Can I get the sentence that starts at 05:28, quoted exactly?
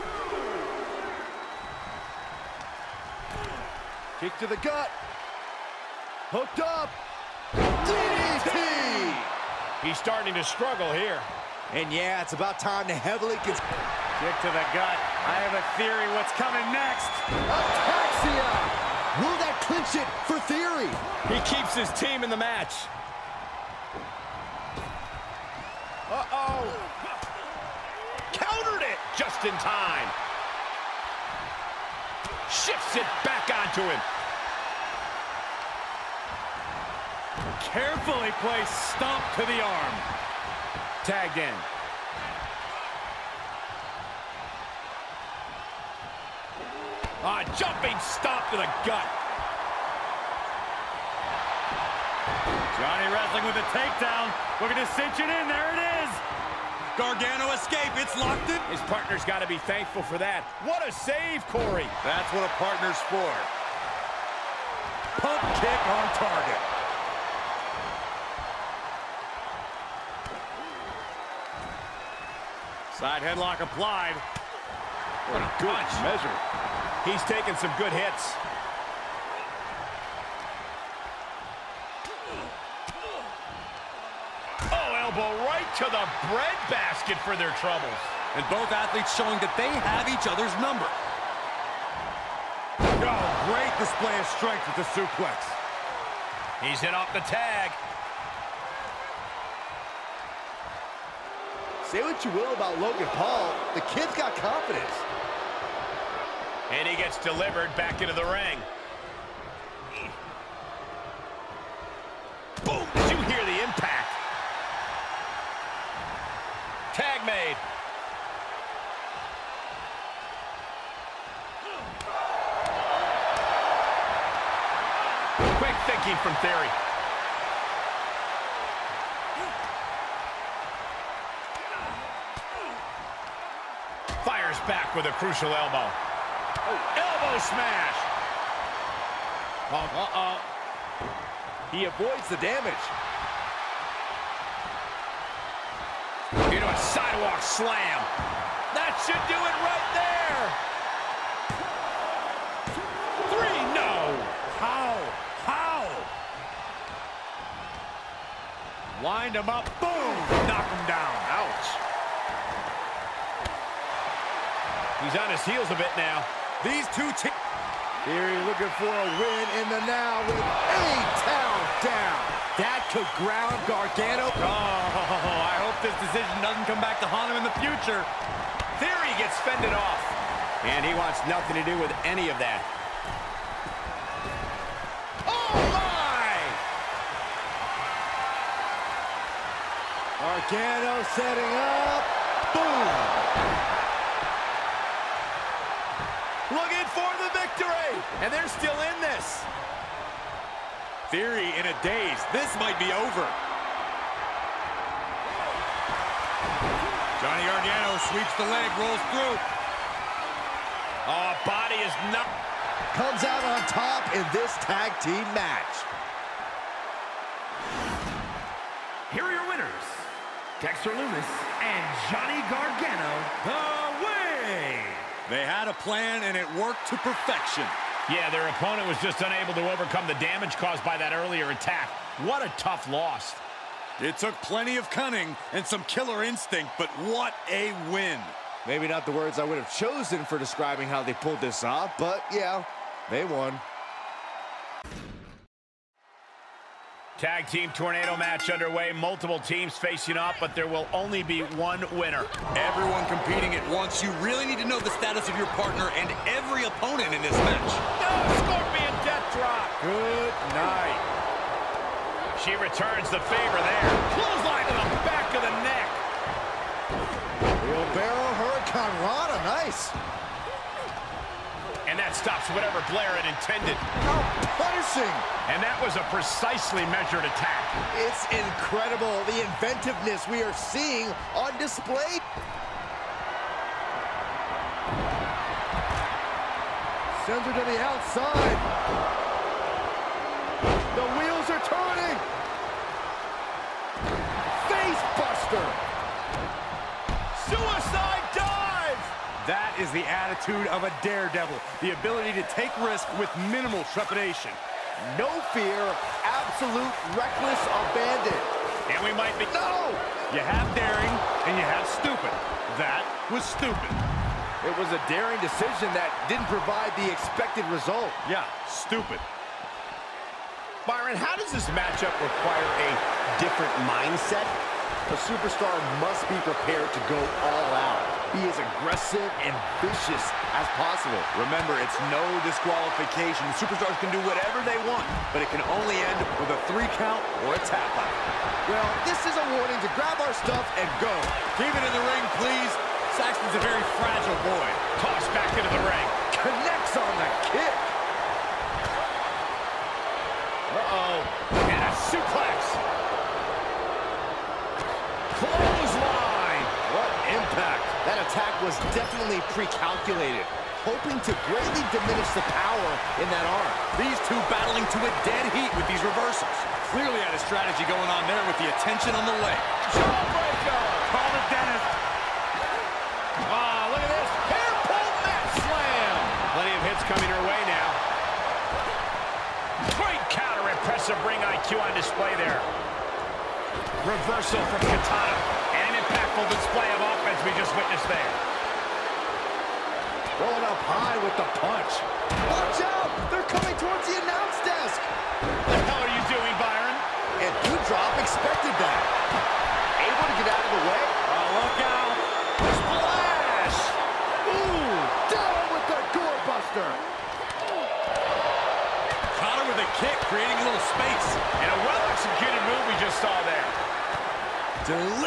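Be as aggressive and vicious as possible.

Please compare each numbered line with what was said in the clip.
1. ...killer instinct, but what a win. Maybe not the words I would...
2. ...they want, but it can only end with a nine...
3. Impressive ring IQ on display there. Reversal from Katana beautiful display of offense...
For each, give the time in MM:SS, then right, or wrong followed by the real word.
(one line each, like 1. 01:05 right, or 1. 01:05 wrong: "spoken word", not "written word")
1. 03:55 right
2. 05:34 wrong: "three", not "nine"
3. 06:20 right.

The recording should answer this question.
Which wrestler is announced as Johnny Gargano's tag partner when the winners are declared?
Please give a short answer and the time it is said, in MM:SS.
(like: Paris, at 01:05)
Dexter Lumis, at 03:40.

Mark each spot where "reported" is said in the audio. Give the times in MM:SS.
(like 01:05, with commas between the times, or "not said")
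not said.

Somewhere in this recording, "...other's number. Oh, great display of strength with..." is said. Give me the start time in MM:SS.
01:30.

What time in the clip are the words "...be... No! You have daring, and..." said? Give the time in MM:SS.
05:09.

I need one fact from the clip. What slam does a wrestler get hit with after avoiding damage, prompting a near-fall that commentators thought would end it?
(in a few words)
Sidewalk slam.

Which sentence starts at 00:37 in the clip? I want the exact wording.
Carefully placed stomp to the arm.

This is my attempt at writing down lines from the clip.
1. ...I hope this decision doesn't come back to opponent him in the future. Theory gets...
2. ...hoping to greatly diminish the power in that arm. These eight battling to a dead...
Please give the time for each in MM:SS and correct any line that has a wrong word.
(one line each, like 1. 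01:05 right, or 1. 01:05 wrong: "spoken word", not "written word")
1. 02:55 wrong: "haunt", not "opponent"
2. 06:00 wrong: "two", not "eight".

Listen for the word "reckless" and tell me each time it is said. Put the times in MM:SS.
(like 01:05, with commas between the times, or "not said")
05:07.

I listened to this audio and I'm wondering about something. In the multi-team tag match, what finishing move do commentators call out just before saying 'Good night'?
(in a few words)
Scorpion death drop.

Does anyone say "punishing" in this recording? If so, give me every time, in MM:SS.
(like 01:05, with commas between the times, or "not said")
04:34.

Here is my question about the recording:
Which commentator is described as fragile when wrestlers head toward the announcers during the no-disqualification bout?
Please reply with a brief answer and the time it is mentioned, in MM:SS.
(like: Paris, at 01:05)
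Saxton, at 05:43.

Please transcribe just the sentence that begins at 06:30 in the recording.
Rolling up high with the punch.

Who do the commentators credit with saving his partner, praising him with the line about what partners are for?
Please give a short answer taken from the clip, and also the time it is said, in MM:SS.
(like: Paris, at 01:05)
Corey, at 01:01.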